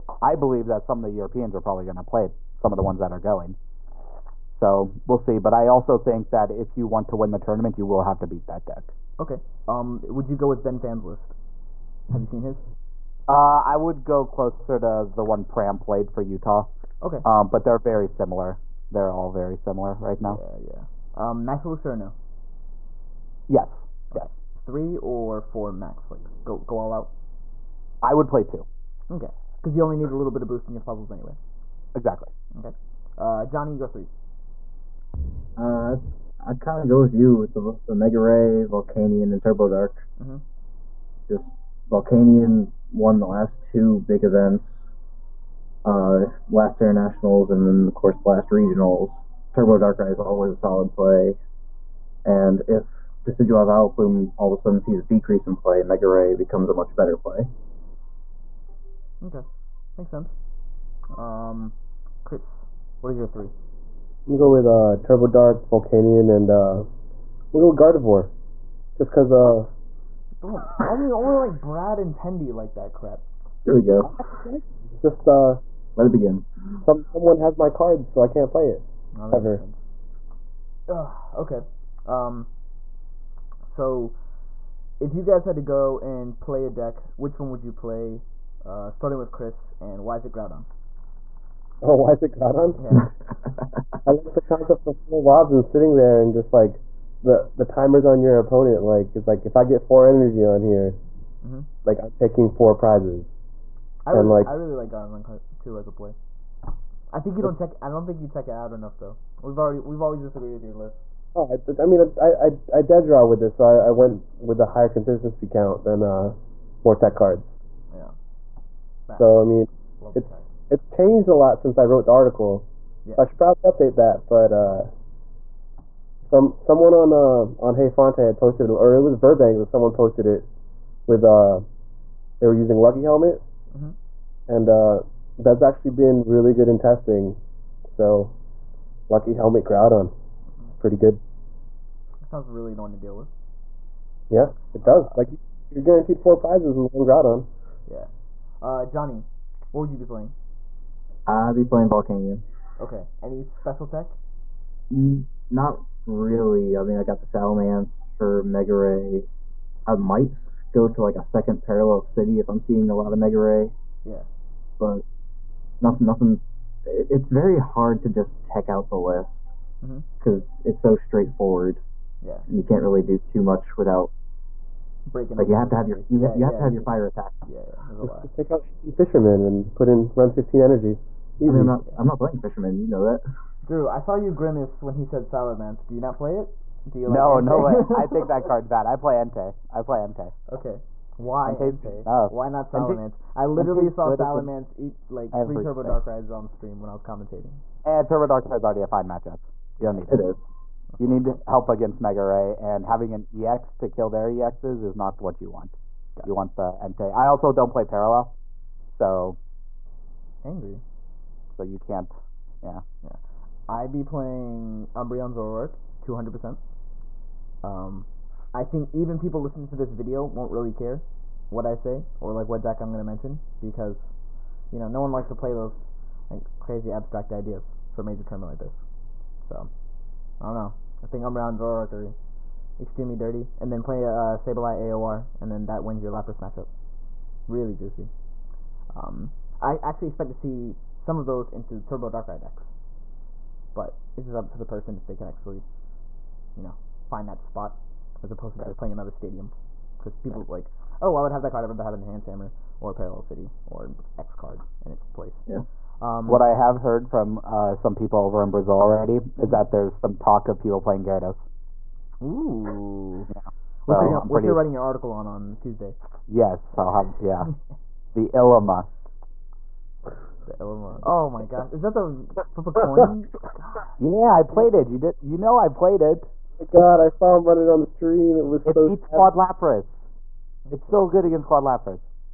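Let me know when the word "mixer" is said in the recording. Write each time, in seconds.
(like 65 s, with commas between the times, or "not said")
not said.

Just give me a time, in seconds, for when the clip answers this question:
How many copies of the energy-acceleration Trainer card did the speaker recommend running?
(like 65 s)
28 s.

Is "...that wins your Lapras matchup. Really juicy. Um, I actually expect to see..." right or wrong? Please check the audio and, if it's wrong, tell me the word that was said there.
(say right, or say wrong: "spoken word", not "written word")
right.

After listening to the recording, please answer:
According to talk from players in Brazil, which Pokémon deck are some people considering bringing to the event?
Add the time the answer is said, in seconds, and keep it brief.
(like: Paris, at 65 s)
Gyarados, at 261 s.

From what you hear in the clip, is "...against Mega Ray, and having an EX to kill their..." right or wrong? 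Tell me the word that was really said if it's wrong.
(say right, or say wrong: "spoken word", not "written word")
right.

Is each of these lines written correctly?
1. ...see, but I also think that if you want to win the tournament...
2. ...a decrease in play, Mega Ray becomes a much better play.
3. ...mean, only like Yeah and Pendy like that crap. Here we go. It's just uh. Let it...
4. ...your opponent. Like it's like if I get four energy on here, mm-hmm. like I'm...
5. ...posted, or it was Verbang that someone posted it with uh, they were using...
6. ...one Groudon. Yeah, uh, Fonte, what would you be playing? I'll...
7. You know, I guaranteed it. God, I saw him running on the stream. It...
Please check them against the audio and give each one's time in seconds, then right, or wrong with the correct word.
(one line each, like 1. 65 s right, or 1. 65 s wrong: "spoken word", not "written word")
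1. 5 s right
2. 55 s right
3. 70 s wrong: "Brad", not "Yeah"
4. 98 s right
5. 128 s right
6. 146 s wrong: "Johnny", not "Fonte"
7. 275 s wrong: "played", not "guaranteed".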